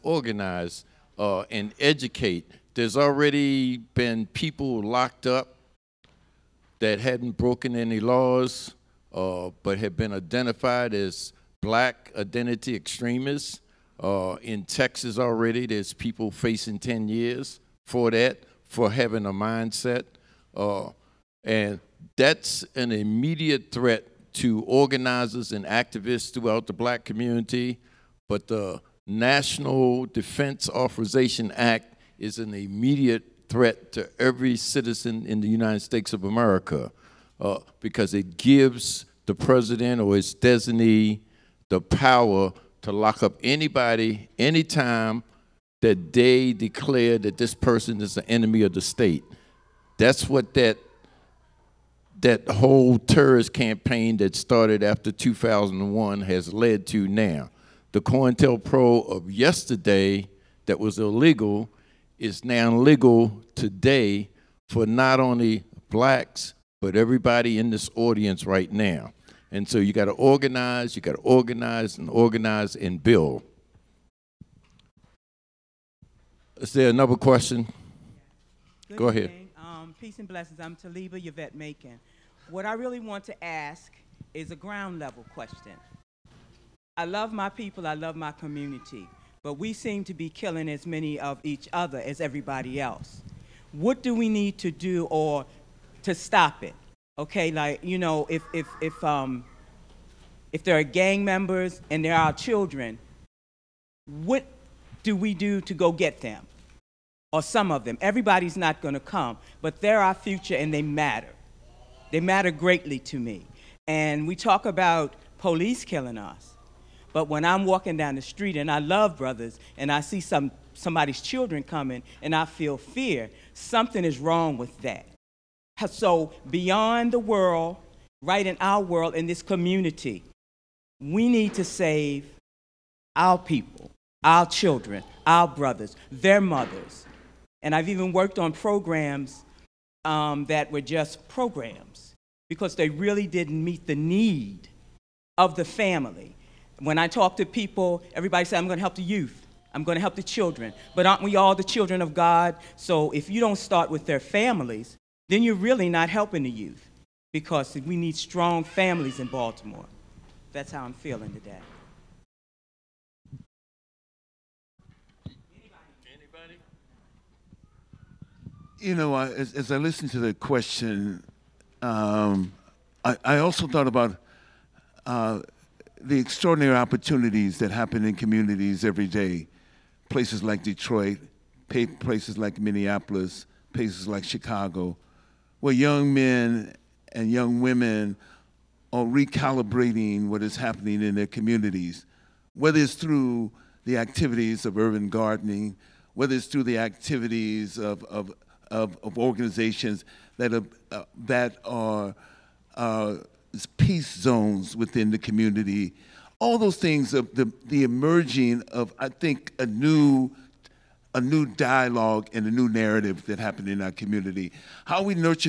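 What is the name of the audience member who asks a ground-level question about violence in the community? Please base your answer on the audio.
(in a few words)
Taliba Yvette Macon.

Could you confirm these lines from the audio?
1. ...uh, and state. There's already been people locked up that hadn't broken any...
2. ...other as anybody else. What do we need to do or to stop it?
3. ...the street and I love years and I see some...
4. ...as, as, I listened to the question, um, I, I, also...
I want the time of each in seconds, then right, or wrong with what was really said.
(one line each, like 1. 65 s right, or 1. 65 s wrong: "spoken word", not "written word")
1. 1 s wrong: "educate", not "state"
2. 91 s wrong: "everybody", not "anybody"
3. 118 s wrong: "brothers", not "years"
4. 169 s right.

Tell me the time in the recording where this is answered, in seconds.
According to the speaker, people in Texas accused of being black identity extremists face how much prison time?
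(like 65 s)
16 s.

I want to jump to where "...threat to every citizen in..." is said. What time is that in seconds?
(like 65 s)
33 s.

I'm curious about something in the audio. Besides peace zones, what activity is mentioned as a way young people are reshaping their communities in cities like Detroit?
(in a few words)
urban gardening.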